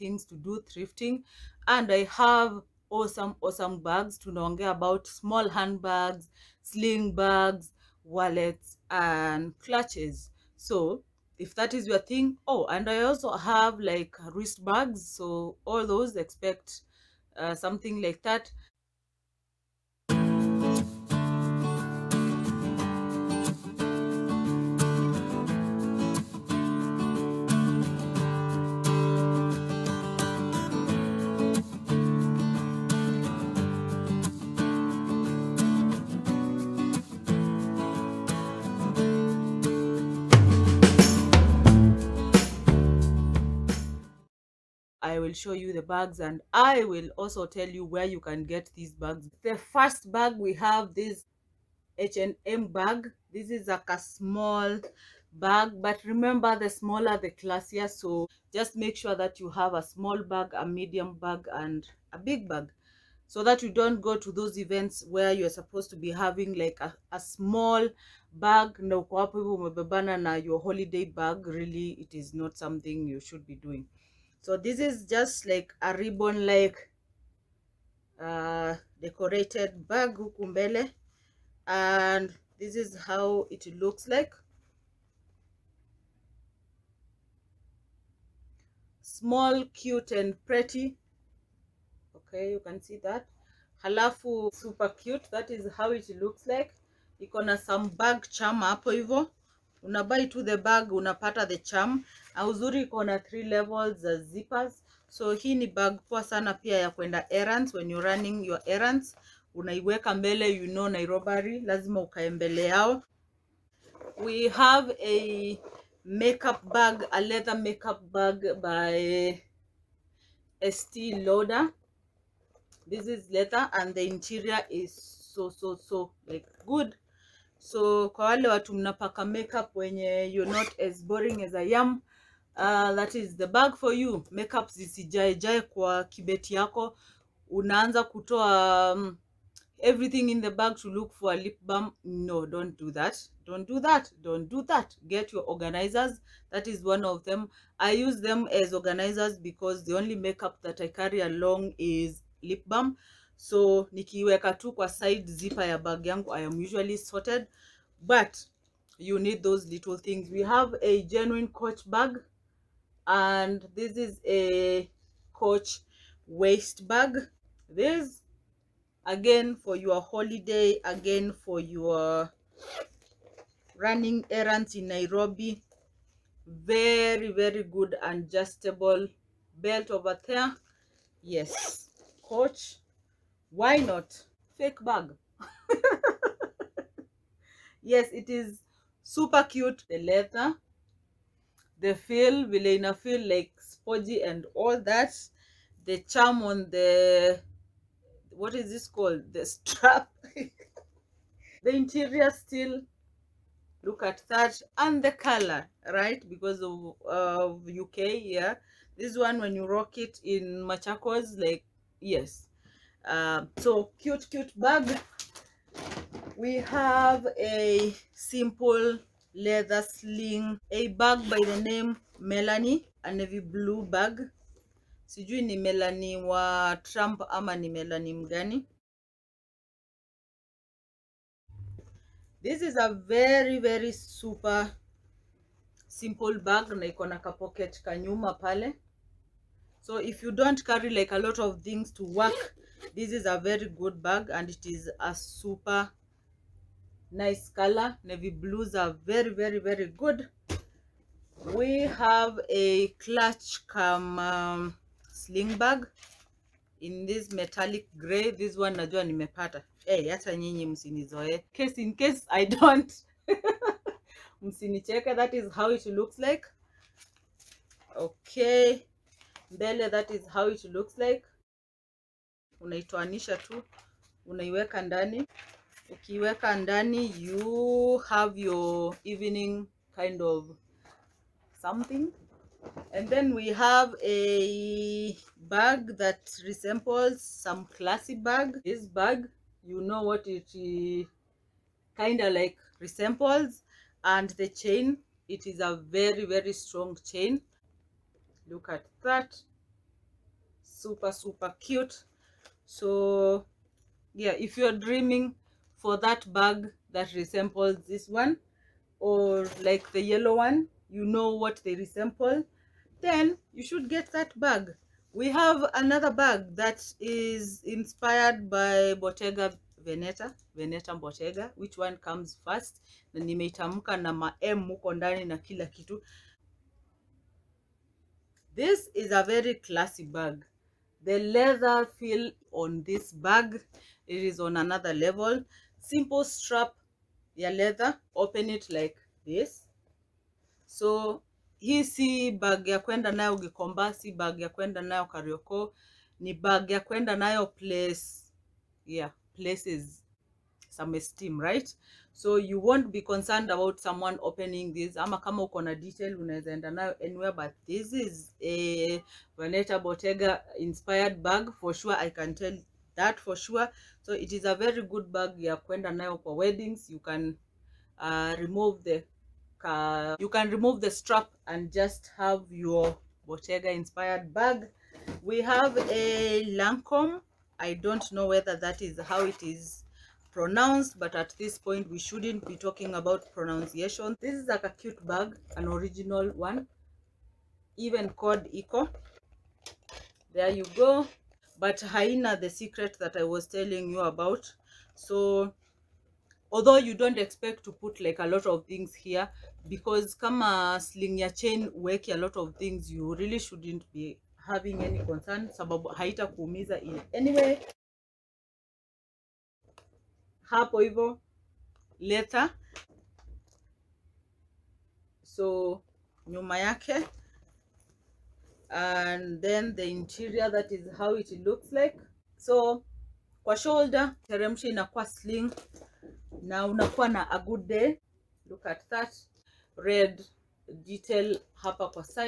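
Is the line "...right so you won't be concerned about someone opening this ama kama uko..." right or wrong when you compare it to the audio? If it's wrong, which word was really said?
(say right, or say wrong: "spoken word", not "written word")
right.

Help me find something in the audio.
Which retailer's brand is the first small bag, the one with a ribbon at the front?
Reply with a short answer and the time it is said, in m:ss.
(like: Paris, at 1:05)
H&M, at 0:51.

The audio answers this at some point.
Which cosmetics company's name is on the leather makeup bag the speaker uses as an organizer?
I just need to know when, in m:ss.
2:00.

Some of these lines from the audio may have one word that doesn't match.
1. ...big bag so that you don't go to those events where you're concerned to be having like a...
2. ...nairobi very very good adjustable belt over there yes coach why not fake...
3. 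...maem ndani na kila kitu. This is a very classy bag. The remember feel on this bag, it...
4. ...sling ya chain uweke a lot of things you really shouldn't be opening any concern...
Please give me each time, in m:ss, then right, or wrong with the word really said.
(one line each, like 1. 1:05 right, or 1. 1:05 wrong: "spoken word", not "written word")
1. 1:02 wrong: "supposed", not "concerned"
2. 2:54 right
3. 5:24 wrong: "leather", not "remember"
4. 6:40 wrong: "having", not "opening".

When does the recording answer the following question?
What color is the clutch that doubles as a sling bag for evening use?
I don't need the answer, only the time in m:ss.
4:17.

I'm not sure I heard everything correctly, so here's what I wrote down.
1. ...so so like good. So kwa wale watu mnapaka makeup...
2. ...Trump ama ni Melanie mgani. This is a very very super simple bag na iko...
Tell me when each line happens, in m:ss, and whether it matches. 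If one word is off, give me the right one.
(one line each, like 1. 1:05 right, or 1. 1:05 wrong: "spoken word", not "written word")
1. 2:05 right
2. 3:46 right.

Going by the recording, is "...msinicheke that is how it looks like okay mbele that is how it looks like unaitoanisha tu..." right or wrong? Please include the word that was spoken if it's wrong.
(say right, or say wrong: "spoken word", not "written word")
right.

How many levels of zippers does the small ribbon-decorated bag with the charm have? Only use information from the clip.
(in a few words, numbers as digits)
3.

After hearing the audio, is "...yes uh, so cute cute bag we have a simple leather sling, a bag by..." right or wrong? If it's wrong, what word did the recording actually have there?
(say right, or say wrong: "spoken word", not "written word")
right.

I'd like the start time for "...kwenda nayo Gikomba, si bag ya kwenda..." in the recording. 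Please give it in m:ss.
5:42.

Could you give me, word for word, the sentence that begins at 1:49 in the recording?
Unaiweka mbele, you know Nairobari, lazima ukae mbele yao.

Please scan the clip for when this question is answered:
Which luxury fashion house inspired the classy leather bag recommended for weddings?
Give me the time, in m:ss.
5:18.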